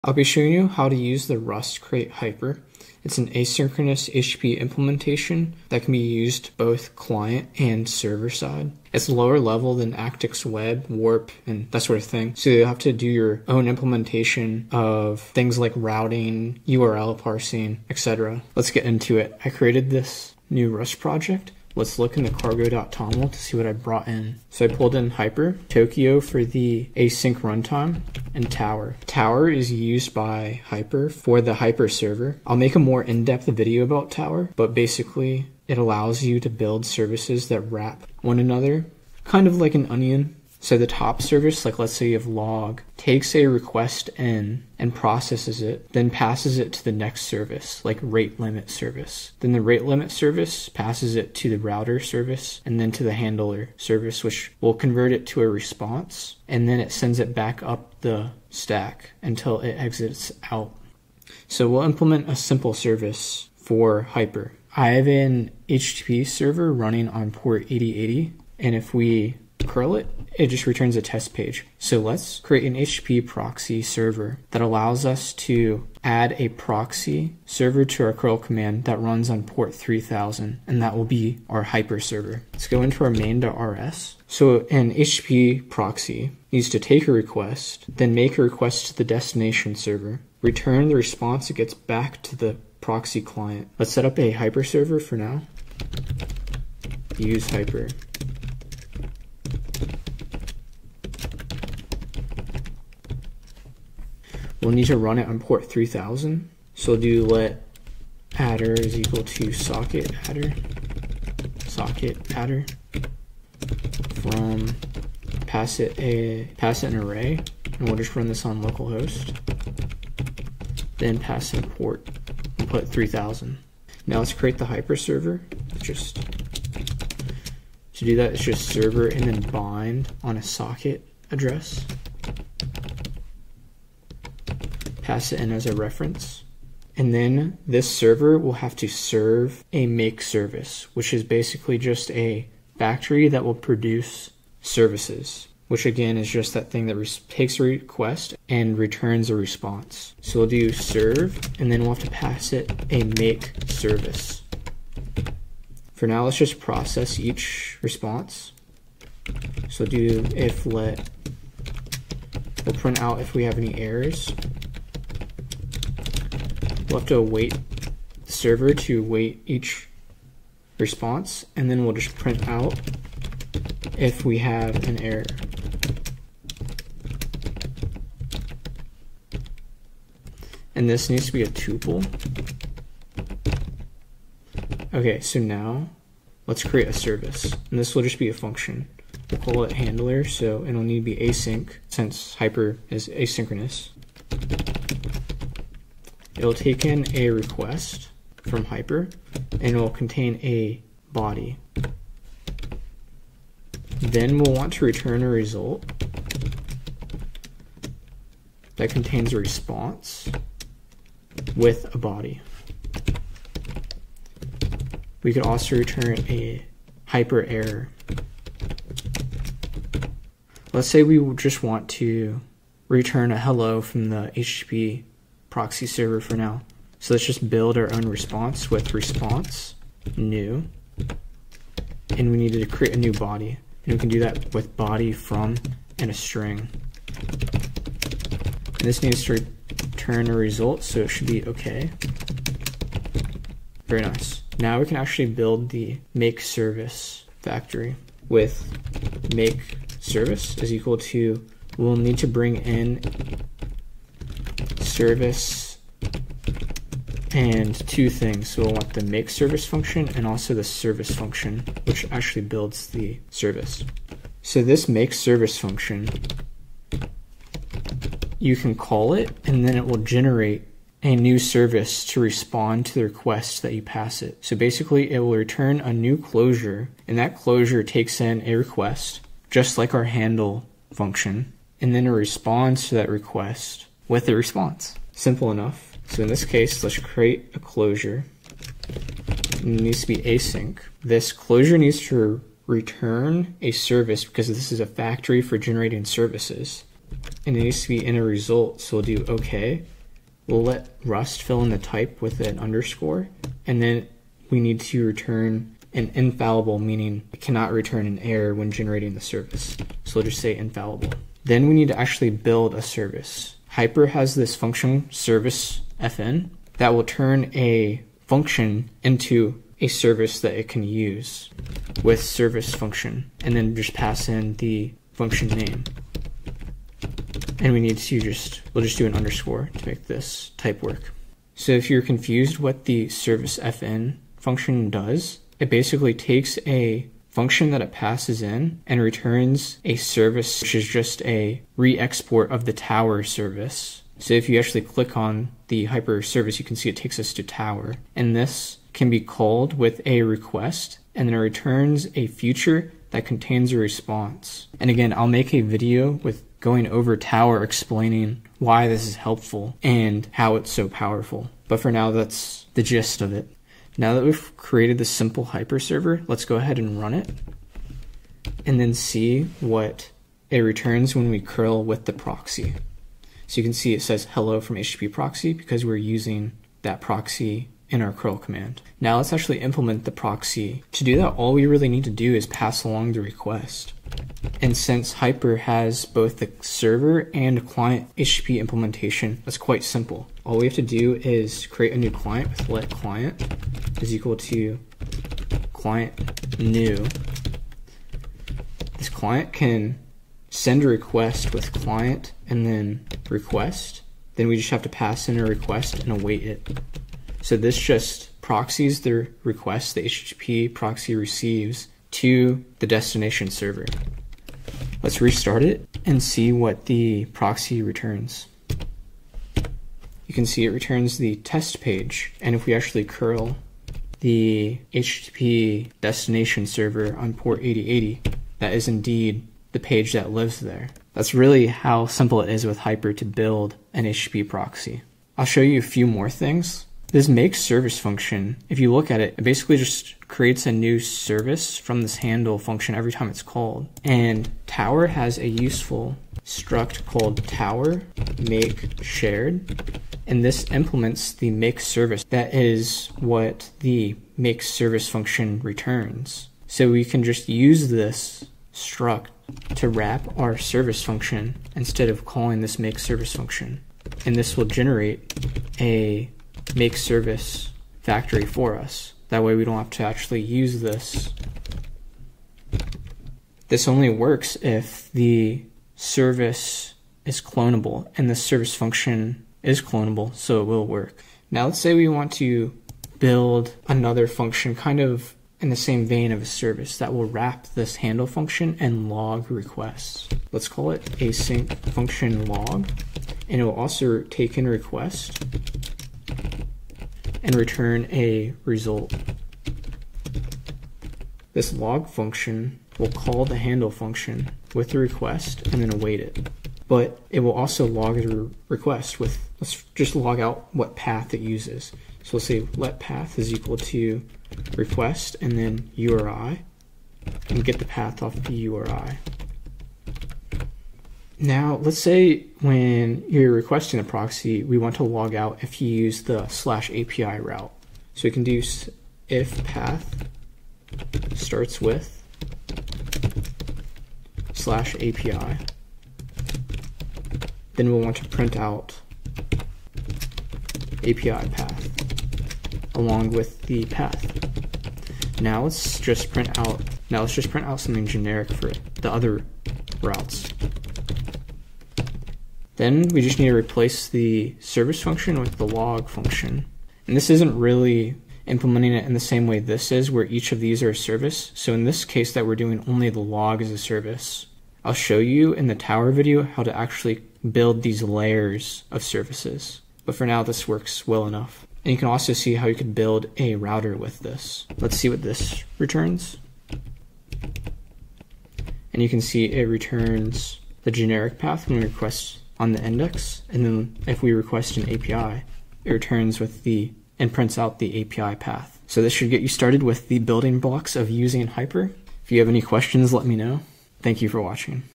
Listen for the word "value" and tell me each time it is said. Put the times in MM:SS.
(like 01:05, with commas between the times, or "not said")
not said.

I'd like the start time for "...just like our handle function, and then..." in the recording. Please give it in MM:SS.
04:39.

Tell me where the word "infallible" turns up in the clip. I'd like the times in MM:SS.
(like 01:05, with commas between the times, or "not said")
05:06, 05:10.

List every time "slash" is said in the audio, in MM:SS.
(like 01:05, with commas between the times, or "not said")
08:46, 08:54.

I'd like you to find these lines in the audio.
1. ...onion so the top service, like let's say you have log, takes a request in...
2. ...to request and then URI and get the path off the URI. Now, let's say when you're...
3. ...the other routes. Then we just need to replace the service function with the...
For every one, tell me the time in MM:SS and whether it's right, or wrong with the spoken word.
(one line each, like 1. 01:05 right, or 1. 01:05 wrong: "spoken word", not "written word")
1. 00:39 right
2. 08:33 right
3. 09:09 right.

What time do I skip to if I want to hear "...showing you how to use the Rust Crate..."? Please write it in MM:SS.
00:00.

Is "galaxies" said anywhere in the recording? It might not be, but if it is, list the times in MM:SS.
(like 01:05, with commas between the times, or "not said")
not said.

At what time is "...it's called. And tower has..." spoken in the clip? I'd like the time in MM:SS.
07:23.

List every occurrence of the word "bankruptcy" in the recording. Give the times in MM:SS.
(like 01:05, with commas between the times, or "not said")
not said.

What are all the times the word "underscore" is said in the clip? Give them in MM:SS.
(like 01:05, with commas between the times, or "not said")
05:02, 05:29.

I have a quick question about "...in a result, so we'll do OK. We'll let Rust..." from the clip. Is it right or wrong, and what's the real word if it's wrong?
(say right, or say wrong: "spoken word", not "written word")
right.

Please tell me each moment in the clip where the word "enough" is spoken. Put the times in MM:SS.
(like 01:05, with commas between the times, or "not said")
04:45, 09:31.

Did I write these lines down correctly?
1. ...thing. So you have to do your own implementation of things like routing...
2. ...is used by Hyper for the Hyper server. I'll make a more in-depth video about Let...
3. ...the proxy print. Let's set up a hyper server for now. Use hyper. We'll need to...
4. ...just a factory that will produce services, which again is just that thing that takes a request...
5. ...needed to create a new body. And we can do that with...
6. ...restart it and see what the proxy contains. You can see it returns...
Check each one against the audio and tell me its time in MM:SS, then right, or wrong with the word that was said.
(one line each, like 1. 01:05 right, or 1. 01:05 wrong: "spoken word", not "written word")
1. 00:12 right
2. 00:29 wrong: "Tower", not "Let"
3. 01:32 wrong: "client", not "print"
4. 02:21 right
5. 03:52 right
6. 06:55 wrong: "returns", not "contains".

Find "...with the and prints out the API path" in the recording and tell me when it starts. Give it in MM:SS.
09:46.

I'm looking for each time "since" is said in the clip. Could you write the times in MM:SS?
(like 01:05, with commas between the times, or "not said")
03:11, 06:24.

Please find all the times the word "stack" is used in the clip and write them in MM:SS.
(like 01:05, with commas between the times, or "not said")
00:58.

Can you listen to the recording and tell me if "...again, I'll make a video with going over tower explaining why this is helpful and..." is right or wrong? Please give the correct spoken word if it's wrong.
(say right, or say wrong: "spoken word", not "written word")
right.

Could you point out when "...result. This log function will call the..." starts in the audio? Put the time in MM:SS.
08:18.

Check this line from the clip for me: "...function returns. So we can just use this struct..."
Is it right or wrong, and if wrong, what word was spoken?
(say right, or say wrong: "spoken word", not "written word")
right.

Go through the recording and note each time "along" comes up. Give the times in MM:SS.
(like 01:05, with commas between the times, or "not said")
06:22, 09:02.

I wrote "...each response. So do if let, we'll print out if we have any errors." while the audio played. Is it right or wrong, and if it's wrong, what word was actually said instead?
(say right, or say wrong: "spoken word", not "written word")
right.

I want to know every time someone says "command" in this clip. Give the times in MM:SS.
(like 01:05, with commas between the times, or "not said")
01:18, 06:18.